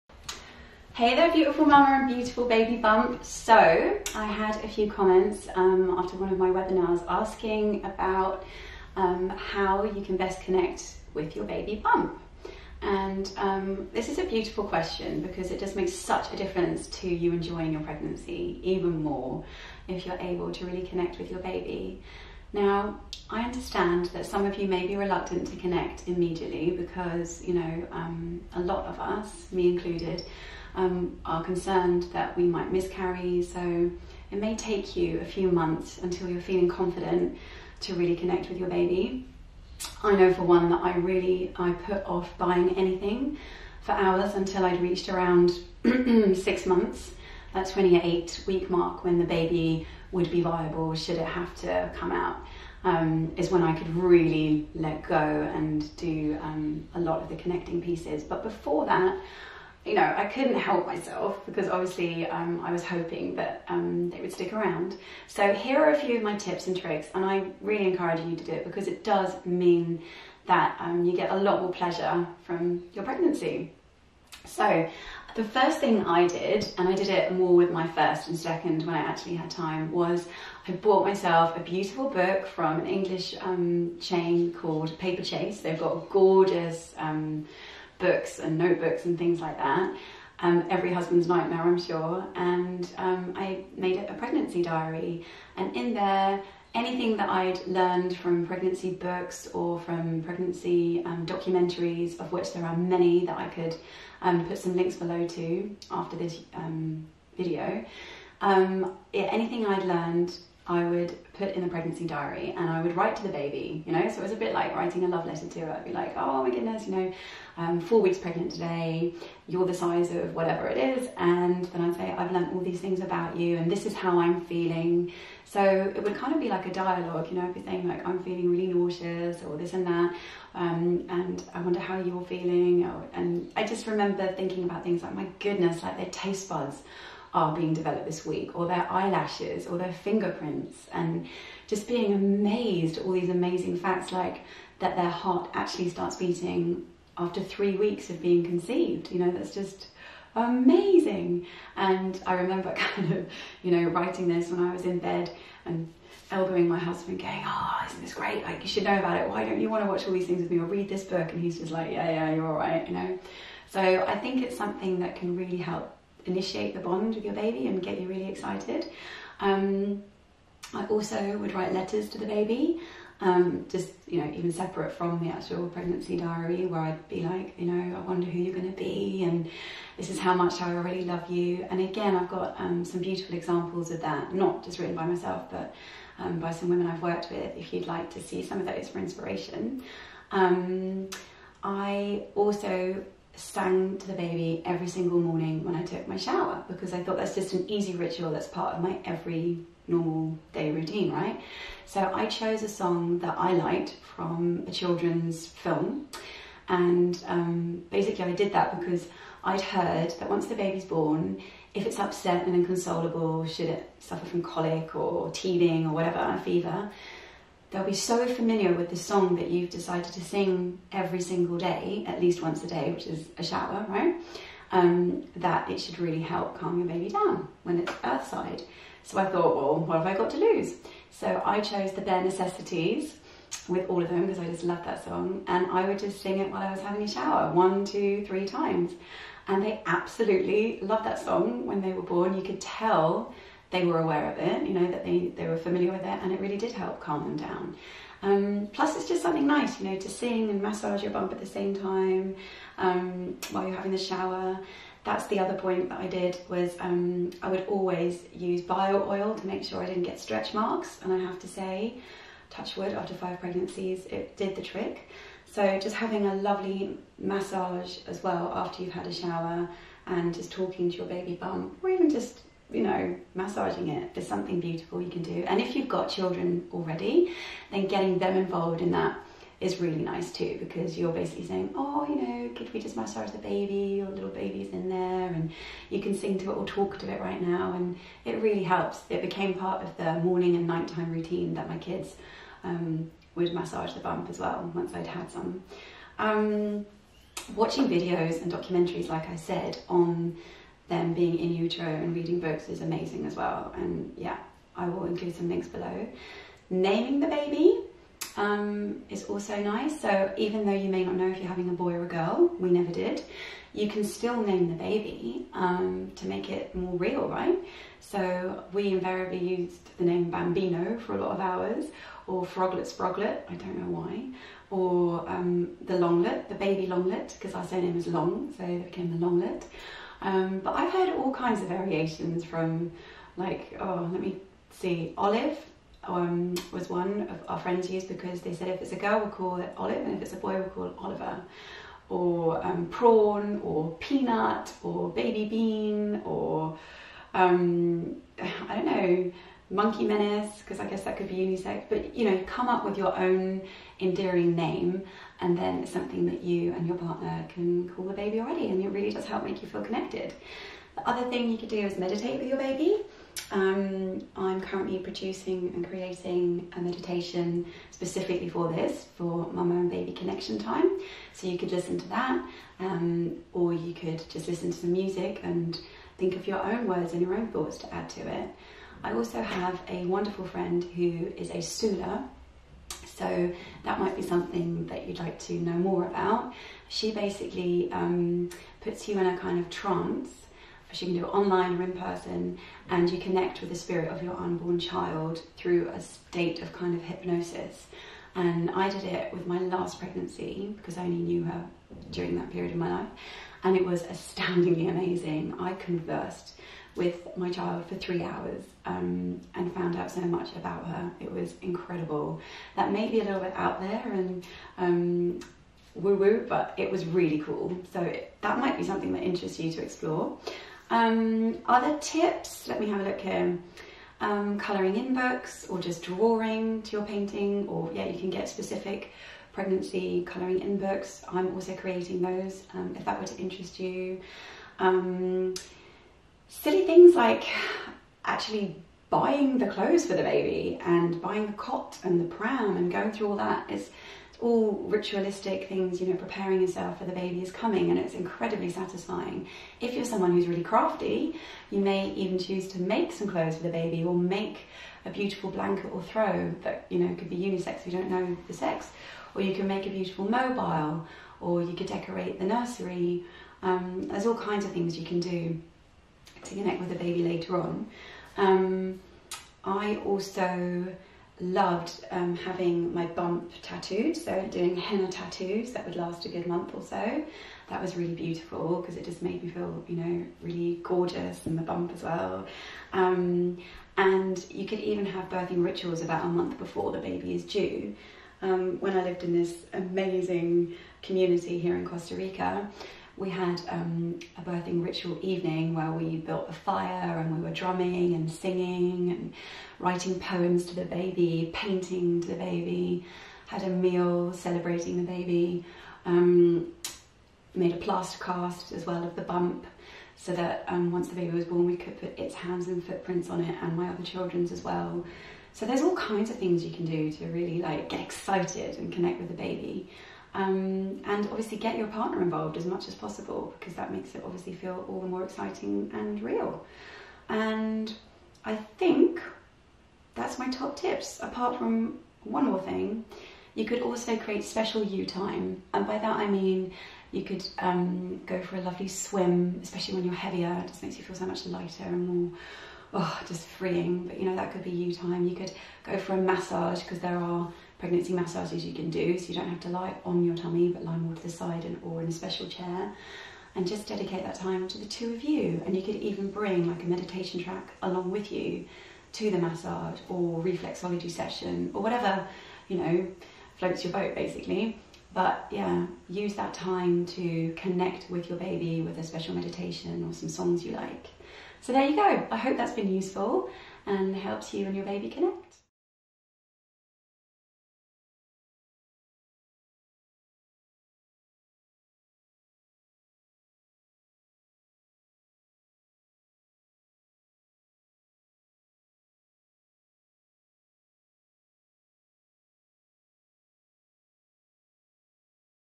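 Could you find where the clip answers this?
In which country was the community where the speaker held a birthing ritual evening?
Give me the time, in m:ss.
8:11.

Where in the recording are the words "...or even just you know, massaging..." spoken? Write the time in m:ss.
4:31.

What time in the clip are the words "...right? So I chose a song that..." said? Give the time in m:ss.
3:21.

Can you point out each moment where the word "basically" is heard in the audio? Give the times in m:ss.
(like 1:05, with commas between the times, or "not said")
3:27, 4:41, 6:27, 9:24.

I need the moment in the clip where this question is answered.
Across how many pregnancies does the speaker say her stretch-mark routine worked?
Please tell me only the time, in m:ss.
4:23.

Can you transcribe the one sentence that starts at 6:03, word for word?
Um, I'm currently producing and creating a meditation specifically for this, for mama and baby connection time.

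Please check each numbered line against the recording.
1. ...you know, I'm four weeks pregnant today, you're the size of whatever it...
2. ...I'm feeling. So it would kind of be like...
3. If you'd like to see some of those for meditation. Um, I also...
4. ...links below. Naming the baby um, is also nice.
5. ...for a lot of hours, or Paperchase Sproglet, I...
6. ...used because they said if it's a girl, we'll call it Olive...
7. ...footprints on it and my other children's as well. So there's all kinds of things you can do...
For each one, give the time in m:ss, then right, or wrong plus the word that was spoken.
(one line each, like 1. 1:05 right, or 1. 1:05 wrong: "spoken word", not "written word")
1. 1:56 right
2. 2:04 right
3. 3:07 wrong: "inspiration", not "meditation"
4. 5:05 right
5. 5:20 wrong: "Froglet", not "Paperchase"
6. 5:37 right
7. 8:32 right.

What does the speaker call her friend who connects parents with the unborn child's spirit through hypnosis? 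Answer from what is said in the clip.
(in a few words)
Sula.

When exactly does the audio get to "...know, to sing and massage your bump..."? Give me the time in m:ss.
4:09.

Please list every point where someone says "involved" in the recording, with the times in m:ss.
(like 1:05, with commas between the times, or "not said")
4:38, 8:42.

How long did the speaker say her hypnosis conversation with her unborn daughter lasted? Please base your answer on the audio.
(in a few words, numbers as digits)
3 hours.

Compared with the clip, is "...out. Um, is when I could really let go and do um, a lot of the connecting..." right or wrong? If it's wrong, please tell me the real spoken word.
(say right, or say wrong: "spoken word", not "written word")
right.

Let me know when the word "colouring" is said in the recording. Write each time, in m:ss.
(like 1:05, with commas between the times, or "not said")
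7:04, 7:10.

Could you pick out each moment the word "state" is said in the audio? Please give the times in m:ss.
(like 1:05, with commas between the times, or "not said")
6:36.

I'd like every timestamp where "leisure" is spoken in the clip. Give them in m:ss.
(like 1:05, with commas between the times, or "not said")
not said.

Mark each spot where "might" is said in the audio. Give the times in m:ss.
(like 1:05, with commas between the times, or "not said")
0:32, 6:23, 6:58.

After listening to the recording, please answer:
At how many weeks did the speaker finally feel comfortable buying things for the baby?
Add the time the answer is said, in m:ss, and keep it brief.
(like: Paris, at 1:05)
28, at 0:47.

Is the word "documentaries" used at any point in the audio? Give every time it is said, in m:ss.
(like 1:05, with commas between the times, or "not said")
1:41, 4:58.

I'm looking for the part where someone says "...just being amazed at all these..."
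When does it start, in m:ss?
2:21.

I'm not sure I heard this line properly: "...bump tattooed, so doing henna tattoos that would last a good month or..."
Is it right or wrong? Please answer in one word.
right.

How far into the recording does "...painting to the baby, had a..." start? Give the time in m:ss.
8:21.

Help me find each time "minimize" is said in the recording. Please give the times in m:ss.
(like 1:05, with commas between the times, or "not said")
not said.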